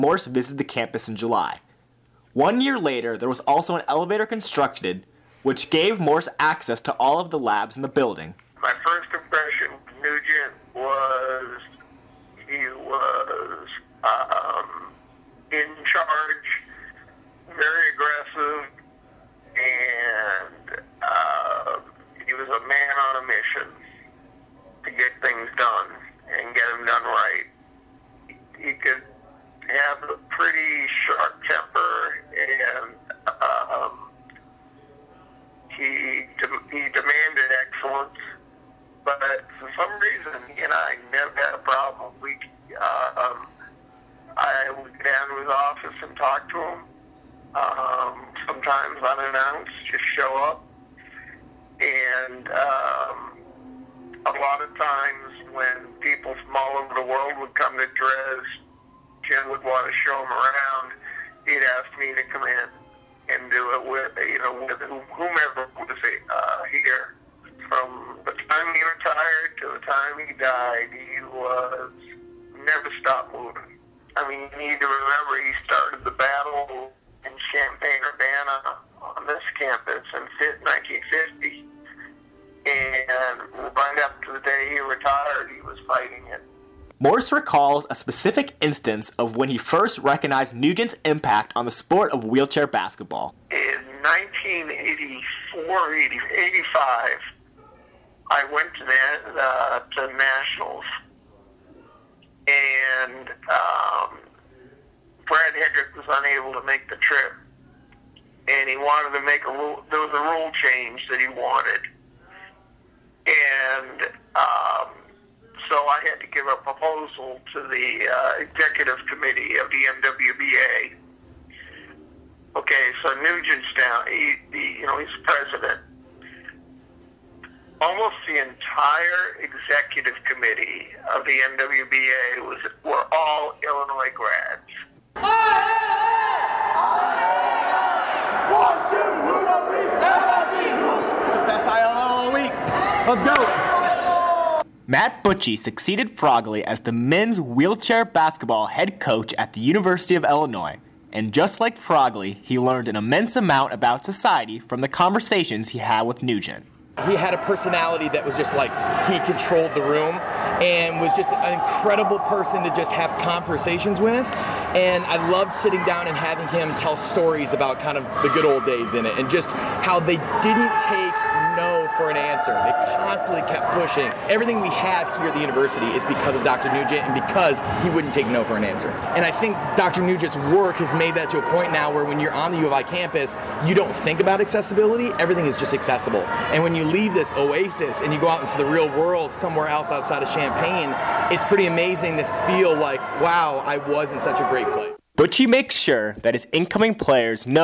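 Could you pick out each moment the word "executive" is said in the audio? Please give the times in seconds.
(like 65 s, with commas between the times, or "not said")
118 s, 129 s.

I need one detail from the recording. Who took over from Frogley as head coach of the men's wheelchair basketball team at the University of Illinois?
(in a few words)
Matt Buchi.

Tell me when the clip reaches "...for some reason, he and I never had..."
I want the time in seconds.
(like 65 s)
39 s.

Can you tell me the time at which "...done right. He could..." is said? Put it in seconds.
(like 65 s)
26 s.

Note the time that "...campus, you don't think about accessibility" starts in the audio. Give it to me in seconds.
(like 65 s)
182 s.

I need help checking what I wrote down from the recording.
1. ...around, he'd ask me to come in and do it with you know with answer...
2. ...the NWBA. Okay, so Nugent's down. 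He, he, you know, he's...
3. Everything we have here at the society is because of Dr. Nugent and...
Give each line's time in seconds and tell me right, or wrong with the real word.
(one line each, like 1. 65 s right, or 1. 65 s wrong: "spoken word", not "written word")
1. 60 s wrong: "whomever", not "answer"
2. 119 s right
3. 174 s wrong: "university", not "society".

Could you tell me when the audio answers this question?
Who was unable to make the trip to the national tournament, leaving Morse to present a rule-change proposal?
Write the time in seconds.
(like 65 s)
105 s.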